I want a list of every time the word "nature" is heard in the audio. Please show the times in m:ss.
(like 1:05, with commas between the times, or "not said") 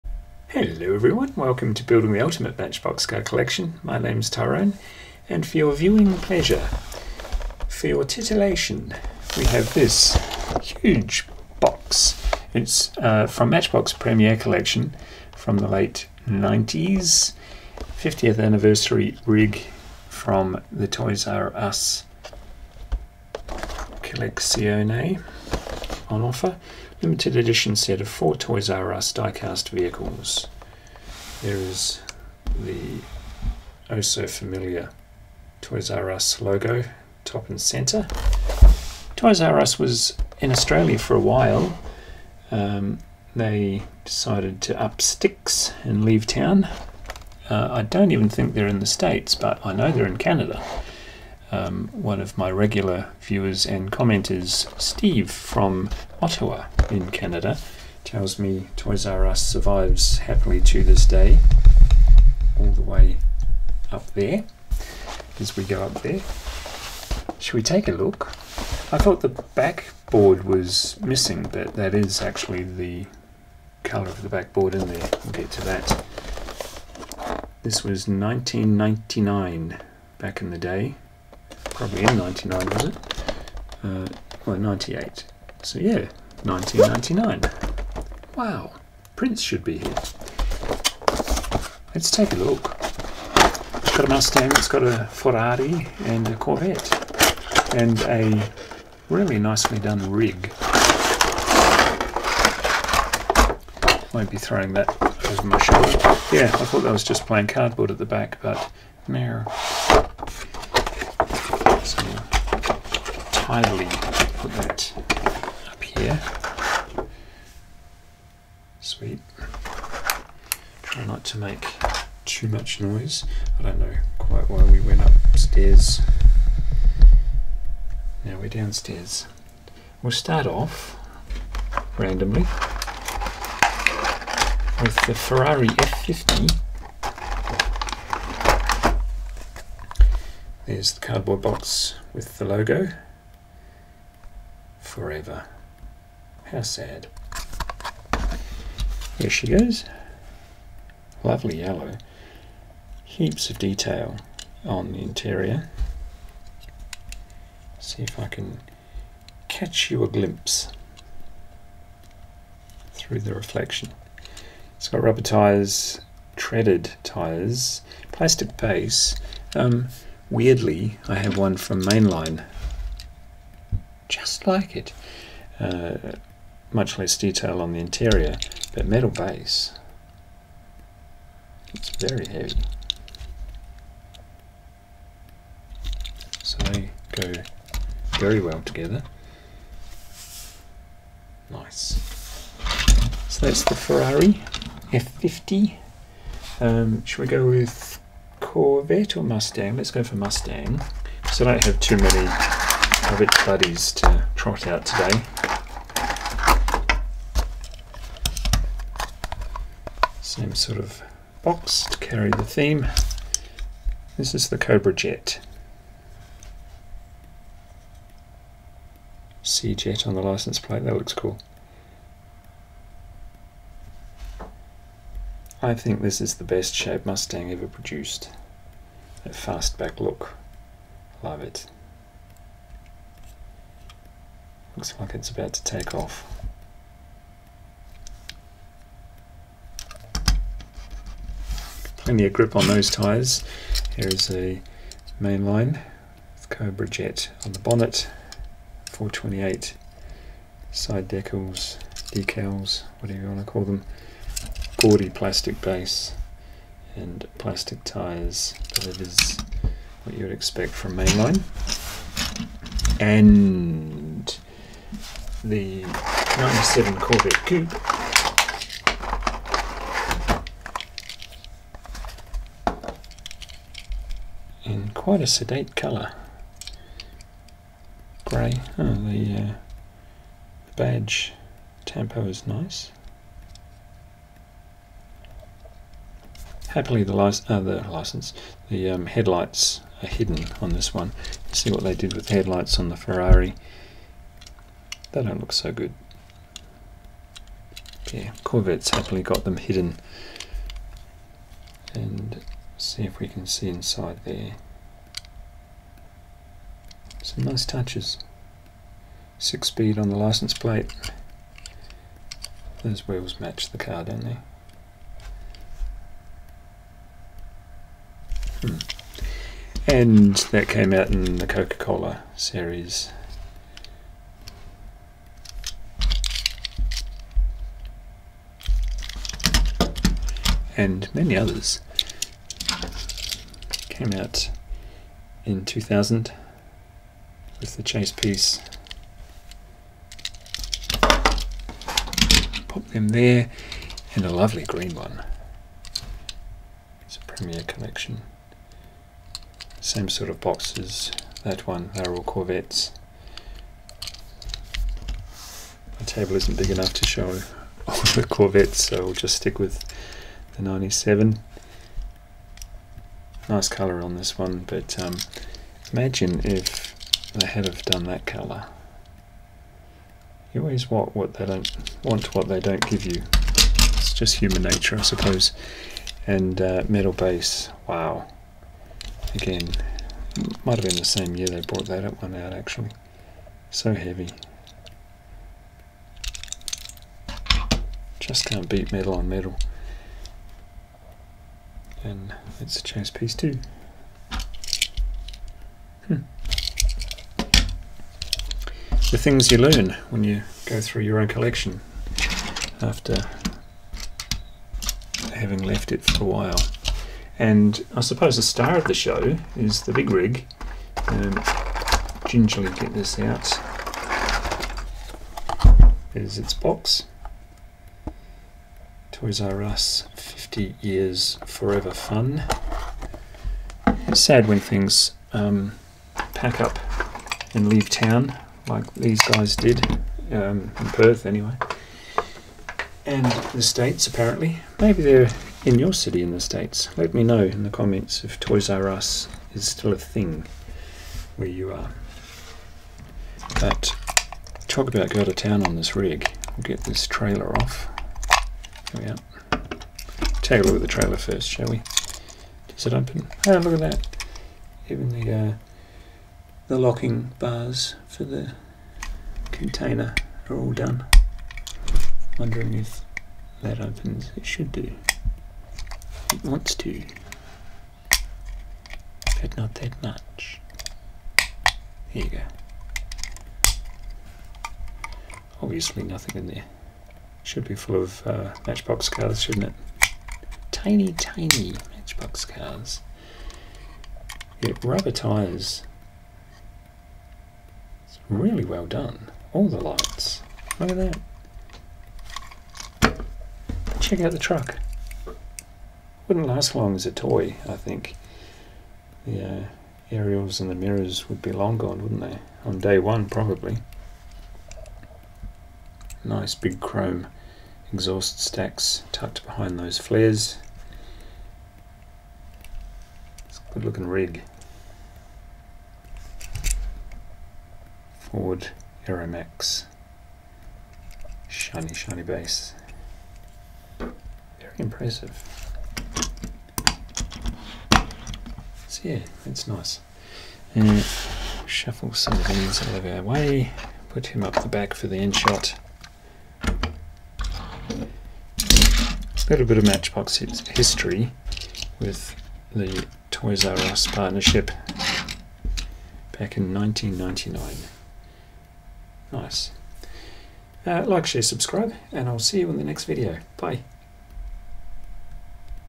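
6:14.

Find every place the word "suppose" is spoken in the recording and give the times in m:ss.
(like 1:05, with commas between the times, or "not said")
6:15, 6:48.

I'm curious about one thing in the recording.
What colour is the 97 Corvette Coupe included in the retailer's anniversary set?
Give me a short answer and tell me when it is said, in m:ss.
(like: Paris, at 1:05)
Grey, at 4:38.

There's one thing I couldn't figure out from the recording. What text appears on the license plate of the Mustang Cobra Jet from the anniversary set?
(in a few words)
Sea Jet.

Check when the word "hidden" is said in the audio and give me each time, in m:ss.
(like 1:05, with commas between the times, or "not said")
4:50, 4:59.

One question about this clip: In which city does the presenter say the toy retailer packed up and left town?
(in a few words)
Perth.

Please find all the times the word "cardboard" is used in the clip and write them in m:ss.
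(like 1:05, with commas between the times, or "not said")
1:47, 2:21.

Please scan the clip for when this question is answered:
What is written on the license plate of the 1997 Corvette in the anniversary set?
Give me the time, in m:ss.
5:09.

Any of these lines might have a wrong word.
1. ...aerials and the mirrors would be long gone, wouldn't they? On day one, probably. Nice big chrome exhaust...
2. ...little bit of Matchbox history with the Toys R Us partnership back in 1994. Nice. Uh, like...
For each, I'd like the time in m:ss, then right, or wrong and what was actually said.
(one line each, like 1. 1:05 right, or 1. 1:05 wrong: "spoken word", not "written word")
1. 8:20 right
2. 8:59 wrong: "1999", not "1994".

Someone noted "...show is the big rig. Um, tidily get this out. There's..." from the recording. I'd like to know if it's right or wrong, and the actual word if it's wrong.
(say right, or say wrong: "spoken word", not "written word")
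wrong: "gingerly", not "tidily".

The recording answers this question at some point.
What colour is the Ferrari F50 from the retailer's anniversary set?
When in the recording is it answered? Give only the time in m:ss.
2:31.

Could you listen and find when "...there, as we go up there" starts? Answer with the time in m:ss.
1:04.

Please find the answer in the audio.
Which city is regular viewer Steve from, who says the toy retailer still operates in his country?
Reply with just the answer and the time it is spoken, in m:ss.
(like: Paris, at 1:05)
Ottawa, at 0:56.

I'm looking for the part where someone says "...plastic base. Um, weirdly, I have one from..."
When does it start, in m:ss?
2:48.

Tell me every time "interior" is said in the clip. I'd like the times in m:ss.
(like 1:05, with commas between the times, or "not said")
2:35, 2:57.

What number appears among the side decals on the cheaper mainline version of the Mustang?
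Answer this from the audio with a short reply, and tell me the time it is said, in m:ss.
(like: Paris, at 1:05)
428, at 4:08.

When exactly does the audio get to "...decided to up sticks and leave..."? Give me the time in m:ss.
0:44.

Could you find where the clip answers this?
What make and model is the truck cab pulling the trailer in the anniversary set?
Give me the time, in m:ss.
8:38.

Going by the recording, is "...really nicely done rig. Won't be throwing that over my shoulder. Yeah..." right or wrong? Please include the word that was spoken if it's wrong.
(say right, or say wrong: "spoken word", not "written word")
right.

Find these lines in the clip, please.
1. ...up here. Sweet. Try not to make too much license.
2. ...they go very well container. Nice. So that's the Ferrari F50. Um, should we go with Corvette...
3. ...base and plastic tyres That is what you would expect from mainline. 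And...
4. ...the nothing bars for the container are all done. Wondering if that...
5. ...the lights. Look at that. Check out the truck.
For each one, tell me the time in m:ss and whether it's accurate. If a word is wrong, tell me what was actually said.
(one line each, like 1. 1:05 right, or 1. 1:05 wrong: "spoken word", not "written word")
1. 1:55 wrong: "noise", not "license"
2. 3:06 wrong: "together", not "container"
3. 4:15 right
4. 7:36 wrong: "locking", not "nothing"
5. 8:09 right.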